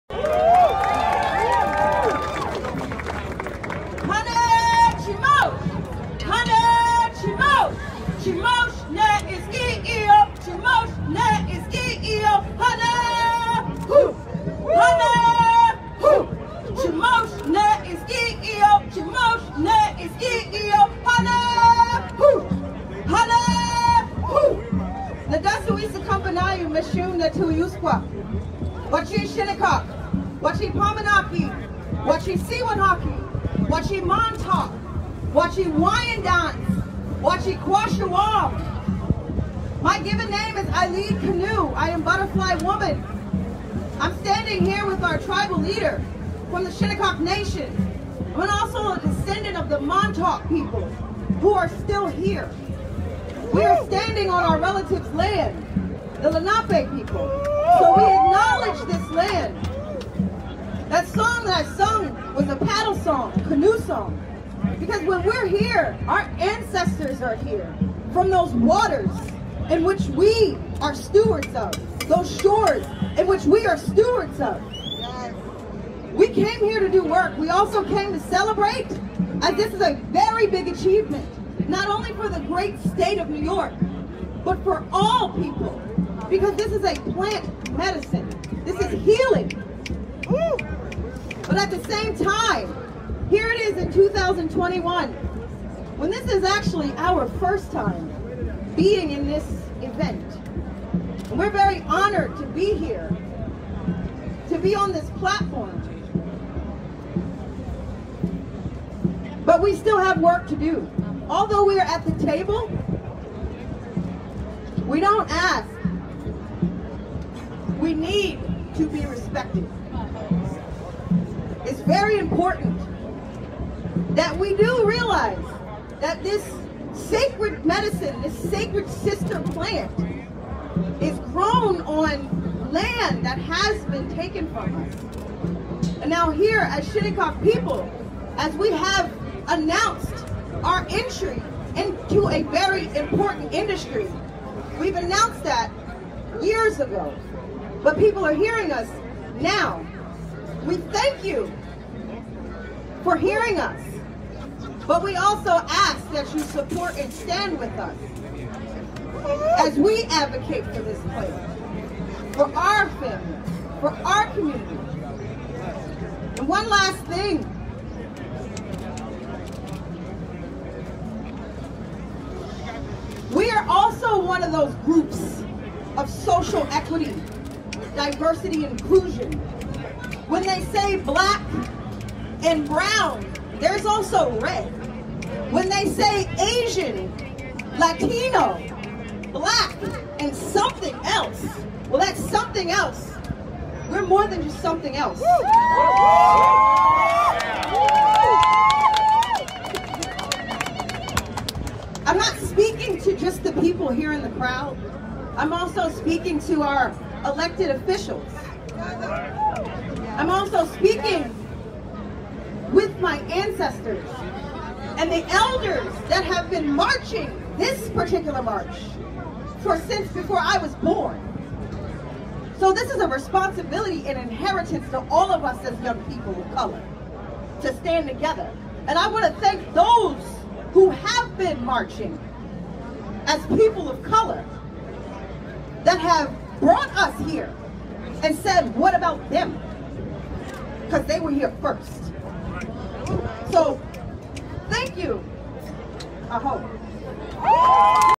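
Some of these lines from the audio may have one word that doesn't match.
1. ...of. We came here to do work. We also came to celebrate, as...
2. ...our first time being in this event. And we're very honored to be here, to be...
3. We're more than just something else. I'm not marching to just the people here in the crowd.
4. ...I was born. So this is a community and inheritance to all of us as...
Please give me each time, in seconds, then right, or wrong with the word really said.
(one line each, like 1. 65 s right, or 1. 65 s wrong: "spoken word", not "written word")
1. 74 s right
2. 96 s right
3. 193 s wrong: "speaking", not "marching"
4. 220 s wrong: "responsibility", not "community".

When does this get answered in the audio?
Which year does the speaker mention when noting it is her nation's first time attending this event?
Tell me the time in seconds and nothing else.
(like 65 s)
93 s.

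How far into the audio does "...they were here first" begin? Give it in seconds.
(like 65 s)
241 s.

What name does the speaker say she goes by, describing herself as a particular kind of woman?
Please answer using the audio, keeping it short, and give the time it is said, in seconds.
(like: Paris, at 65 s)
Butterfly Woman, at 42 s.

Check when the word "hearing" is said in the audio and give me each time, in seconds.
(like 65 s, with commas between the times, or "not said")
148 s, 153 s.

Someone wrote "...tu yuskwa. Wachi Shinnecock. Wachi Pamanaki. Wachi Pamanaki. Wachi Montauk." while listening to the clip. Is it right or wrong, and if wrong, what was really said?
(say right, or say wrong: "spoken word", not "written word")
wrong: "Siwanaki", not "Pamanaki".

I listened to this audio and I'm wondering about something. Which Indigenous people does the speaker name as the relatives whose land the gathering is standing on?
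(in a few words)
Lenape.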